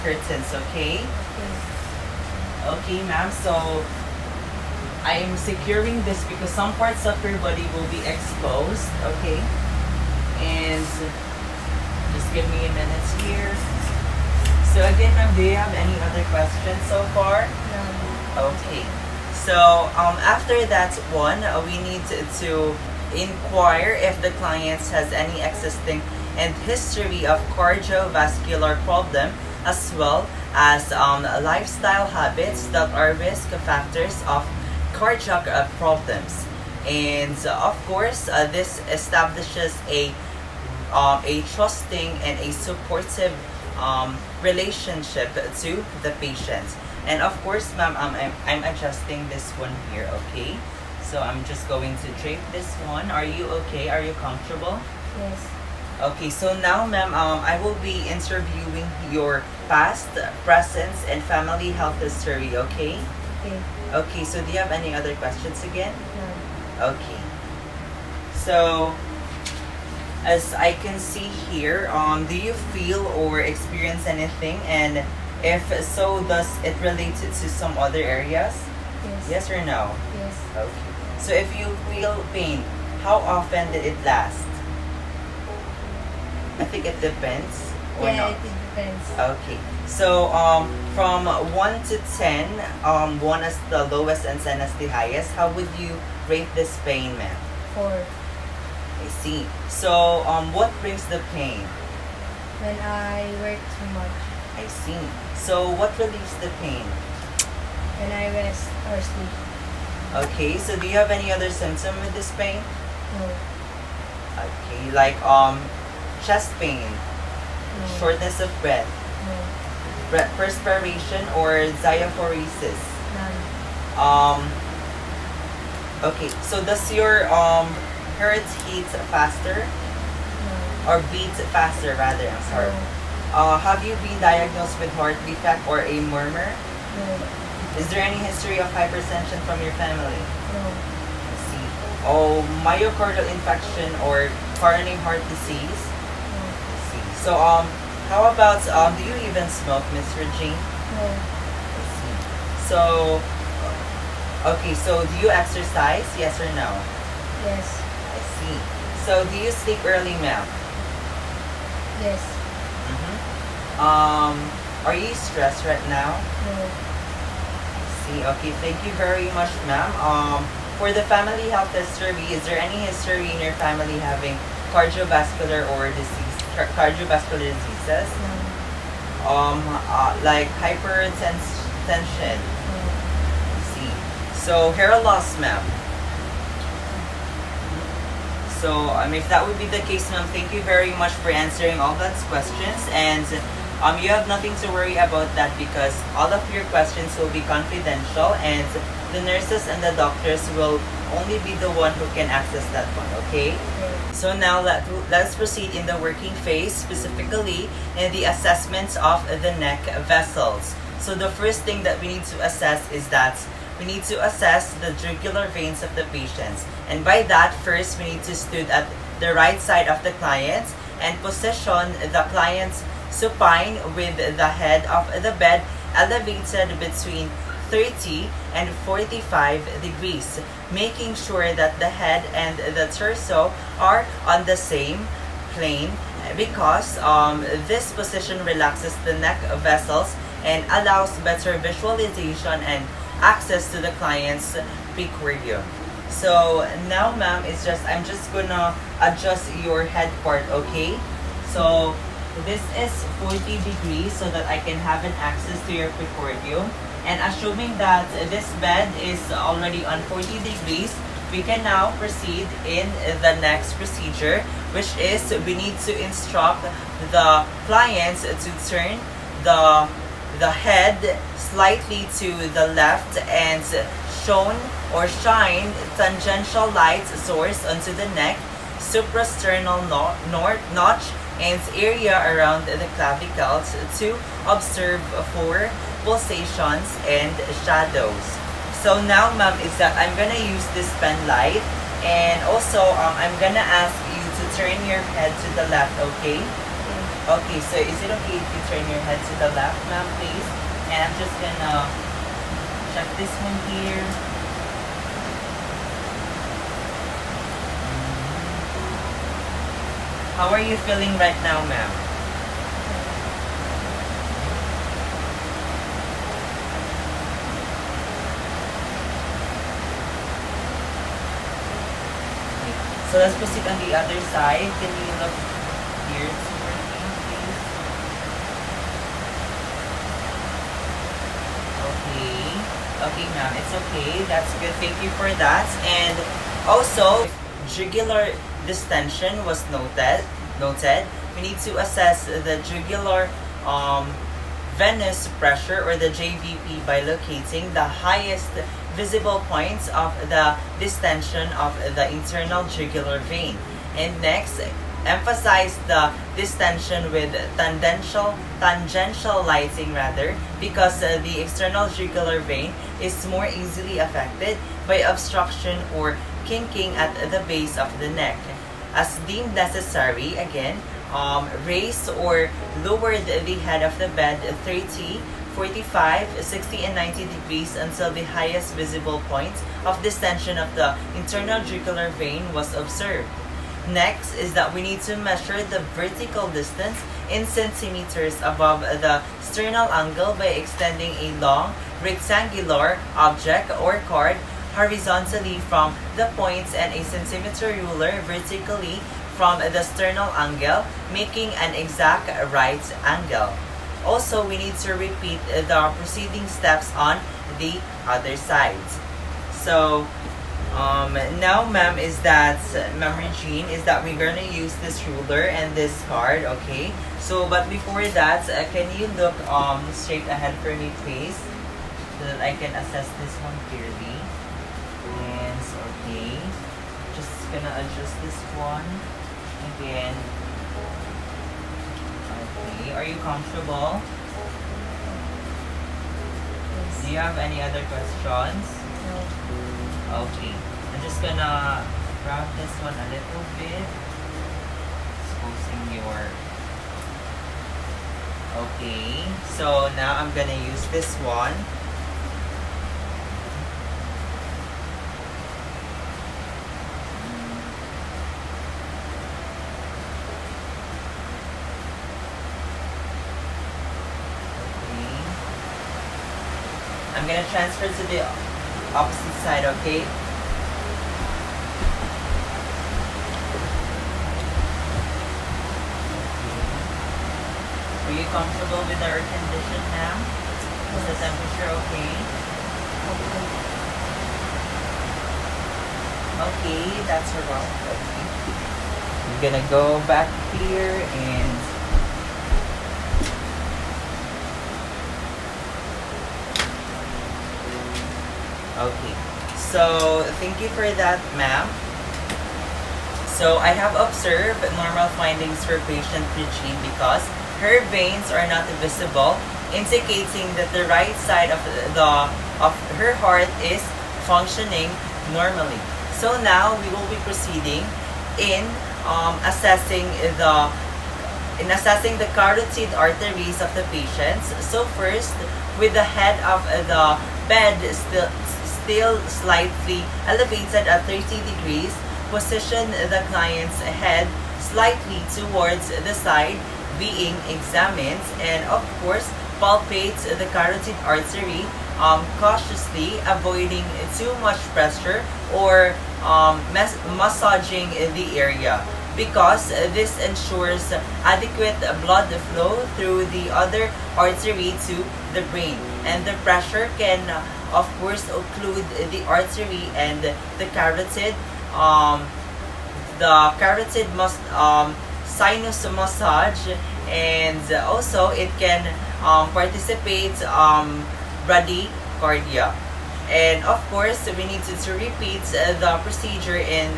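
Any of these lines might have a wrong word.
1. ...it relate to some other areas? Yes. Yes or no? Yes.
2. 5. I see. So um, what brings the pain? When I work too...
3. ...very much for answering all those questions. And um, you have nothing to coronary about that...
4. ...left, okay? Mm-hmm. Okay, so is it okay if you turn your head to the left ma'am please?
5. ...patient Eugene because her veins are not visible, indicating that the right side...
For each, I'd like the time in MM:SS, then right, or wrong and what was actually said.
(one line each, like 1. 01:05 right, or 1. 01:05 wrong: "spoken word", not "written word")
1. 01:16 right
2. 01:37 wrong: "4", not "5"
3. 03:10 wrong: "worry", not "coronary"
4. 04:55 right
5. 08:25 right.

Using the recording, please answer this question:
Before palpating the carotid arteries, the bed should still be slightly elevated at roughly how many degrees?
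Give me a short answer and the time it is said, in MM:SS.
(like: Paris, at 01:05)
30 degrees, at 08:51.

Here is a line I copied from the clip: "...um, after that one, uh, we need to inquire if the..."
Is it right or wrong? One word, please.
right.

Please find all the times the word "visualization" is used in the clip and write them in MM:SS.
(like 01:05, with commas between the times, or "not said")
04:01.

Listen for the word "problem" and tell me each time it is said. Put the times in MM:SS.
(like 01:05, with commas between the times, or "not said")
00:28, 00:35.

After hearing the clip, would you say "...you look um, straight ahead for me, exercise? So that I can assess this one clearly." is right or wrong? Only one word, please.
wrong.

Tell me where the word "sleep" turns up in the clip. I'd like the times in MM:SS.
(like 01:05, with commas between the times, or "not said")
01:49, 02:39.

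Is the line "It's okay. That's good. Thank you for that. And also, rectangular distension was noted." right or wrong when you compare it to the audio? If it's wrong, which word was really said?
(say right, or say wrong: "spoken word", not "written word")
wrong: "jugular", not "rectangular".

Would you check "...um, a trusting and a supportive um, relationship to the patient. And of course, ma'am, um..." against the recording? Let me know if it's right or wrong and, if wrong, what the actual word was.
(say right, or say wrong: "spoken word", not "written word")
right.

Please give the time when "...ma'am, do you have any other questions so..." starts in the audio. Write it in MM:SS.
00:15.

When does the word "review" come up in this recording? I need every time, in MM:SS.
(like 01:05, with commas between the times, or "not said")
04:05, 04:16.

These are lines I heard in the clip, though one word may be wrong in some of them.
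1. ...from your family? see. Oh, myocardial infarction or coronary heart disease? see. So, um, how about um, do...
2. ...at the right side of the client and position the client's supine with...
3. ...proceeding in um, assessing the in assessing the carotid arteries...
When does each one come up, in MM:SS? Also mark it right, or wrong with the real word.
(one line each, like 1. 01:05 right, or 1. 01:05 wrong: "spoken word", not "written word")
1. 02:19 right
2. 03:38 right
3. 08:37 right.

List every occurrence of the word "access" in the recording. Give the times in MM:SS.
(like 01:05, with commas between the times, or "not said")
03:22, 04:03, 04:15.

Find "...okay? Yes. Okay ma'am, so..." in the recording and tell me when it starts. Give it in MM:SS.
00:00.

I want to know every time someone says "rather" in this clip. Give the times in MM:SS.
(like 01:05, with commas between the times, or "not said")
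02:11, 05:59.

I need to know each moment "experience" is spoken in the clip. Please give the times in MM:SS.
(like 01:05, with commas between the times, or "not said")
01:13.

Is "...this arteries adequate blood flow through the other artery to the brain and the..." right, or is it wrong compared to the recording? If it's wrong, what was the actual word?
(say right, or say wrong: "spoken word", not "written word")
wrong: "ensures", not "arteries".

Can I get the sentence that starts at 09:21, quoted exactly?
Um, the carotid must um, sinus massage and also it can um, participate um, bradycardia.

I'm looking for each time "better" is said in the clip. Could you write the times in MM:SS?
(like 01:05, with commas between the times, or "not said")
04:01.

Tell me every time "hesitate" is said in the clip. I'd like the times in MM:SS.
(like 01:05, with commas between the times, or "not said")
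not said.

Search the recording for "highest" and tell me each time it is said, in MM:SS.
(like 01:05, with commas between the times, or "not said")
01:34, 05:47, 06:18.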